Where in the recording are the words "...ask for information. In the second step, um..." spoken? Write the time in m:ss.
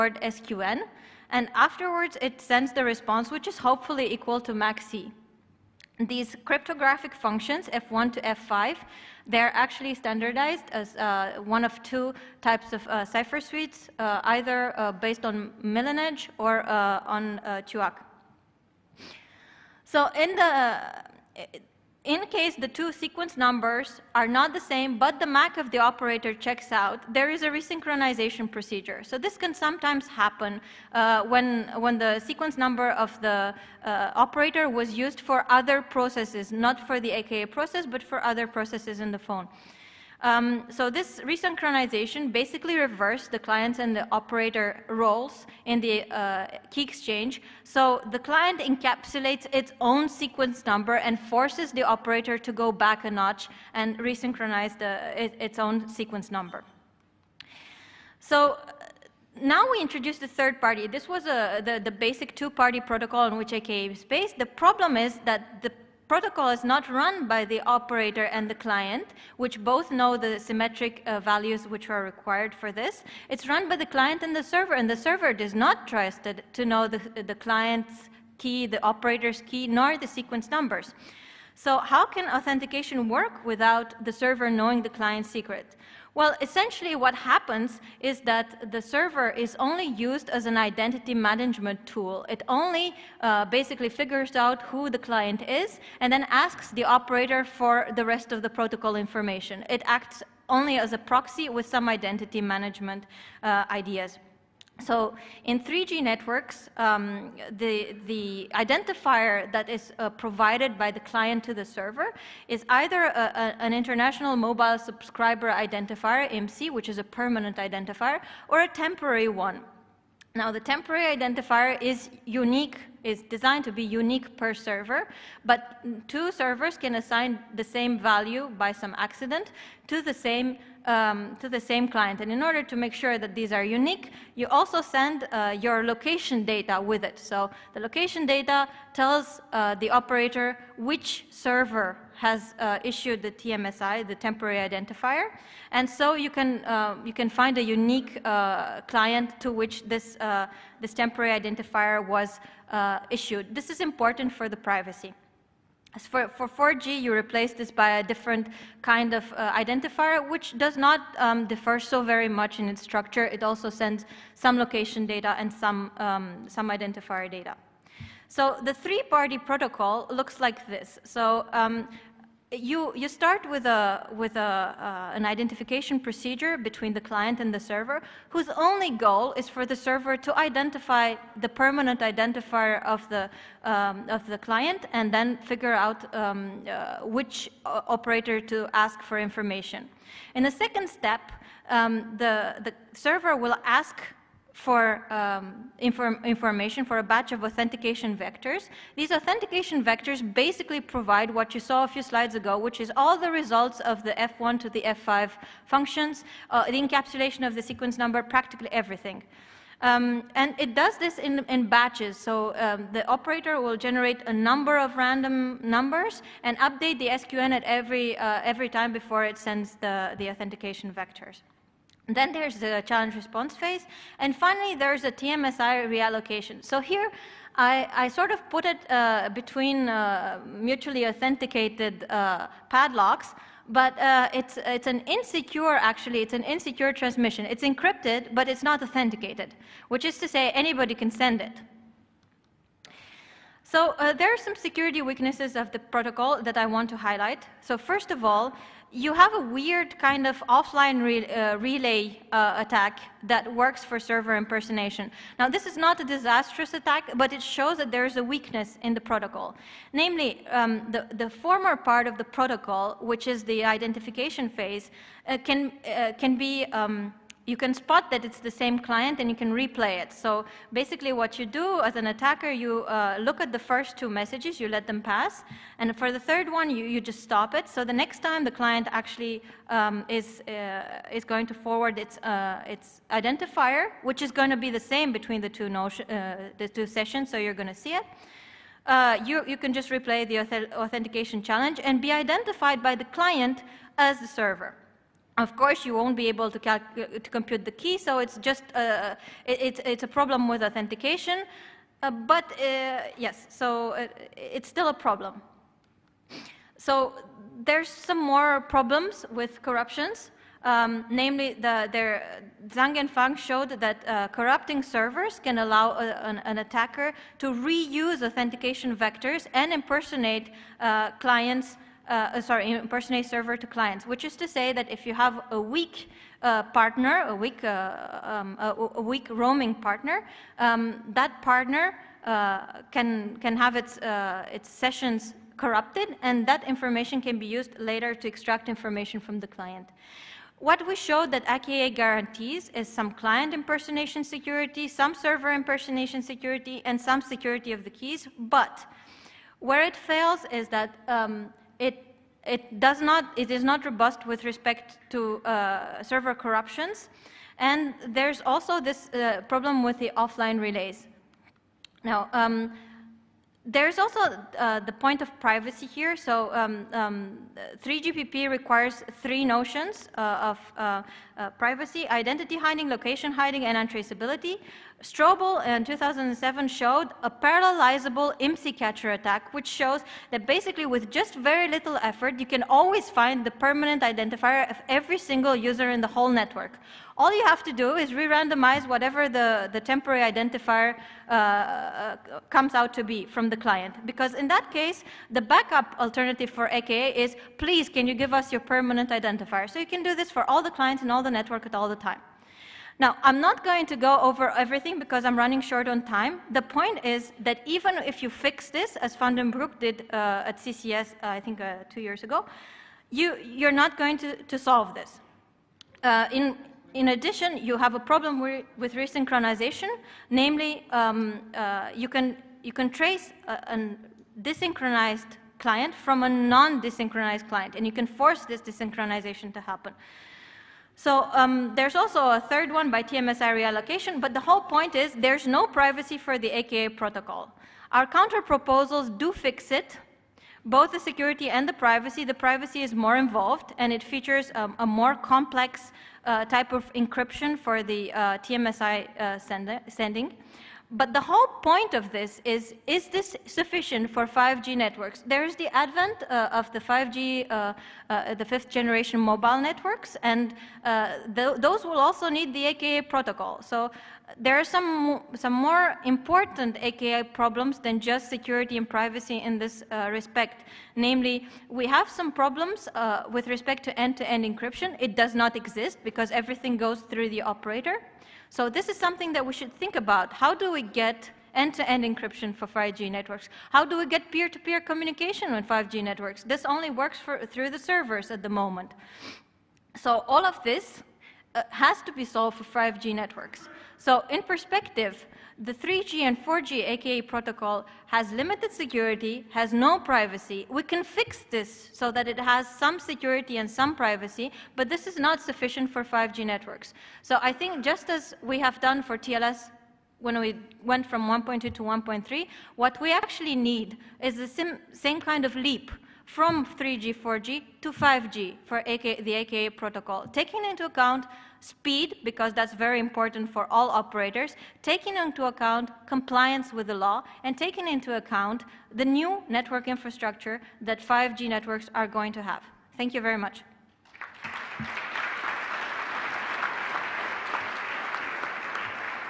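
3:08.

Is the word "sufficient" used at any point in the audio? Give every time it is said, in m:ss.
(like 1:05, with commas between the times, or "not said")
7:33, 8:25.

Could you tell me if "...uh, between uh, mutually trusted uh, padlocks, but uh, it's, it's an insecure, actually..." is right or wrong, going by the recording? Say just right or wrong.
wrong.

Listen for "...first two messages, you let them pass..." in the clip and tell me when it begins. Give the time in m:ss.
4:33.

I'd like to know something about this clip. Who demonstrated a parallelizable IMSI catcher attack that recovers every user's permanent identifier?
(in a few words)
Strobel.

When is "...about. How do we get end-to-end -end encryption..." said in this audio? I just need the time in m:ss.
7:59.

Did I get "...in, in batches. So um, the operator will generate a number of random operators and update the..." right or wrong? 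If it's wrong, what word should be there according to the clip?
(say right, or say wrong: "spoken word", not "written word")
wrong: "numbers", not "operators".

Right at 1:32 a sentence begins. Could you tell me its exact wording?
It only uh, basically figures out who the client is and then asks the operator for the rest of the protocol information.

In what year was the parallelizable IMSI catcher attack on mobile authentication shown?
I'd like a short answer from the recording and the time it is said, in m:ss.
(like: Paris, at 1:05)
2007, at 6:15.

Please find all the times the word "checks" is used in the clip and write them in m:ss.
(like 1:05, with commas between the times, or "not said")
0:26.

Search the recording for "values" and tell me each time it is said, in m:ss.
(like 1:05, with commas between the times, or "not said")
1:11, 2:07.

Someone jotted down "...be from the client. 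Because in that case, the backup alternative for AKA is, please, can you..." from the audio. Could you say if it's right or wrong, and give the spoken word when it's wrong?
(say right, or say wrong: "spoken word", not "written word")
right.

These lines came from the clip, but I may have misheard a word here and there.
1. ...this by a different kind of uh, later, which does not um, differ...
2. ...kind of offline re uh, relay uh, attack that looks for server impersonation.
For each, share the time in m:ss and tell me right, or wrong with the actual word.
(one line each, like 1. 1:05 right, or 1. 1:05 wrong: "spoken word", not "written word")
1. 2:37 wrong: "identifier", not "later"
2. 4:09 wrong: "works", not "looks".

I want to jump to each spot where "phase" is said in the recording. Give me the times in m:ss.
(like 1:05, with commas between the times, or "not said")
3:43, 4:24.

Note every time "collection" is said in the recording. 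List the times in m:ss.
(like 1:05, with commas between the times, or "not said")
not said.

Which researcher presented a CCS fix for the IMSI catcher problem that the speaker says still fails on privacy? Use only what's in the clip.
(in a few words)
Van den Broek.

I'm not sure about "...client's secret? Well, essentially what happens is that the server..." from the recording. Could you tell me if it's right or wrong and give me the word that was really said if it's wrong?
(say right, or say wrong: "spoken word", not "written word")
right.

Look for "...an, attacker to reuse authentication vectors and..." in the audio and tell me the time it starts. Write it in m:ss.
5:16.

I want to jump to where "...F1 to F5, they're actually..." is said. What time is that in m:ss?
0:07.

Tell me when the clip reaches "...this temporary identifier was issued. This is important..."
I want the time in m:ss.
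2:30.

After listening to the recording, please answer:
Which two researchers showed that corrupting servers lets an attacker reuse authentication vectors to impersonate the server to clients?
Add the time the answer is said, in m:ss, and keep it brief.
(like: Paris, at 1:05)
Zhang and Fang, at 5:12.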